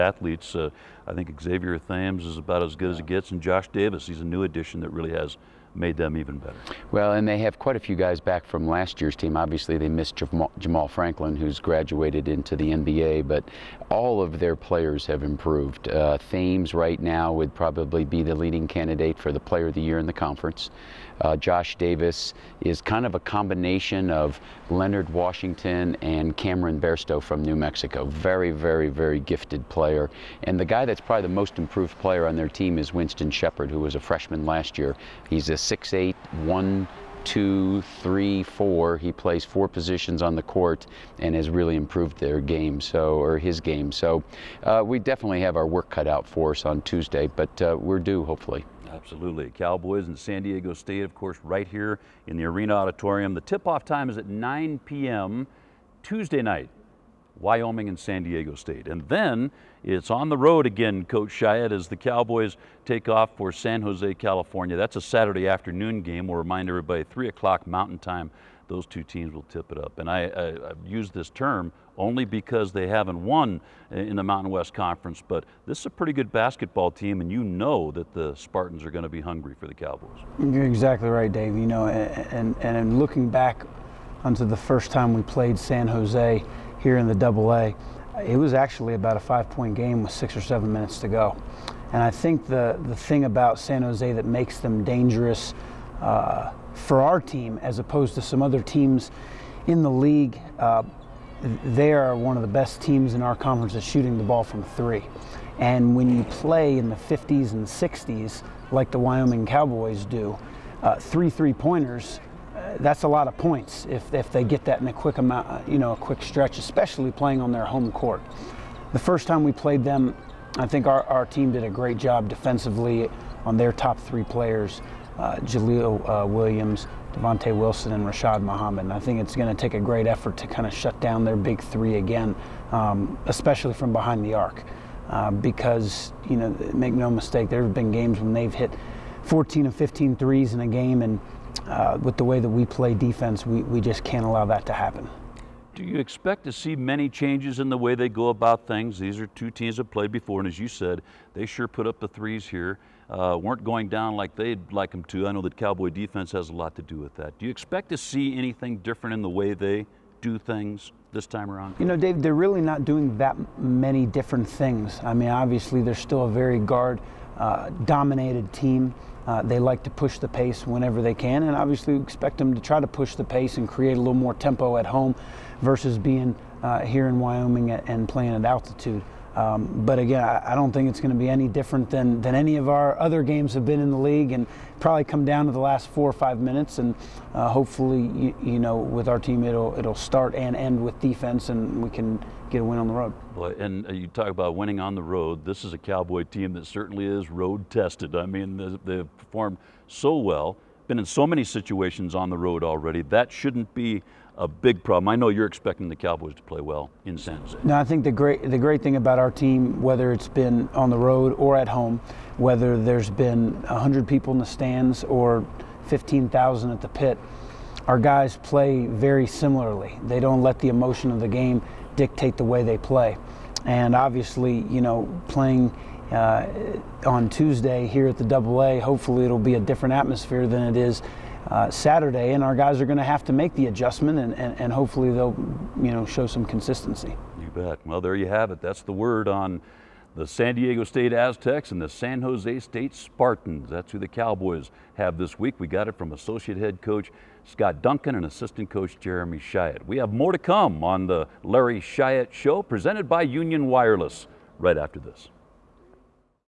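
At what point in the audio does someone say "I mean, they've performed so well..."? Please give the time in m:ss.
3:18.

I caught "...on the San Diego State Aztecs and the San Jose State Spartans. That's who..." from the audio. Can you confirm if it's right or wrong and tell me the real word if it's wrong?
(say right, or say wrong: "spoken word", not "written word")
right.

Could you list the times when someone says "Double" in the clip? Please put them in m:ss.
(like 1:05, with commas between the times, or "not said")
1:27, 3:48.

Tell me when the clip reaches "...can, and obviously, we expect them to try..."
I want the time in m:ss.
2:51.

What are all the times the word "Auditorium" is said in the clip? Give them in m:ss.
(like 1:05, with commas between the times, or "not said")
0:52.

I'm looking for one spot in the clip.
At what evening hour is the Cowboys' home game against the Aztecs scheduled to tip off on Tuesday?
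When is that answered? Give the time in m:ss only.
0:54.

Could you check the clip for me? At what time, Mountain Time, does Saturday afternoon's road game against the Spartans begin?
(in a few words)
3 o'clock.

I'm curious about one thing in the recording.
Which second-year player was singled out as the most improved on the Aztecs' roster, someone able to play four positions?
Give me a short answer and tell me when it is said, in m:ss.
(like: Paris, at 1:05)
Winston Shepard, at 0:32.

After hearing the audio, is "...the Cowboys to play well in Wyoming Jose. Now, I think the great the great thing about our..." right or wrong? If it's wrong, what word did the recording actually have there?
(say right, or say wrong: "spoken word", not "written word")
wrong: "San", not "Wyoming".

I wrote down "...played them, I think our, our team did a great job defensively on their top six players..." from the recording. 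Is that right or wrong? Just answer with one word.
wrong.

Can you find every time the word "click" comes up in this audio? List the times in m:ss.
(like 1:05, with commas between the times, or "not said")
not said.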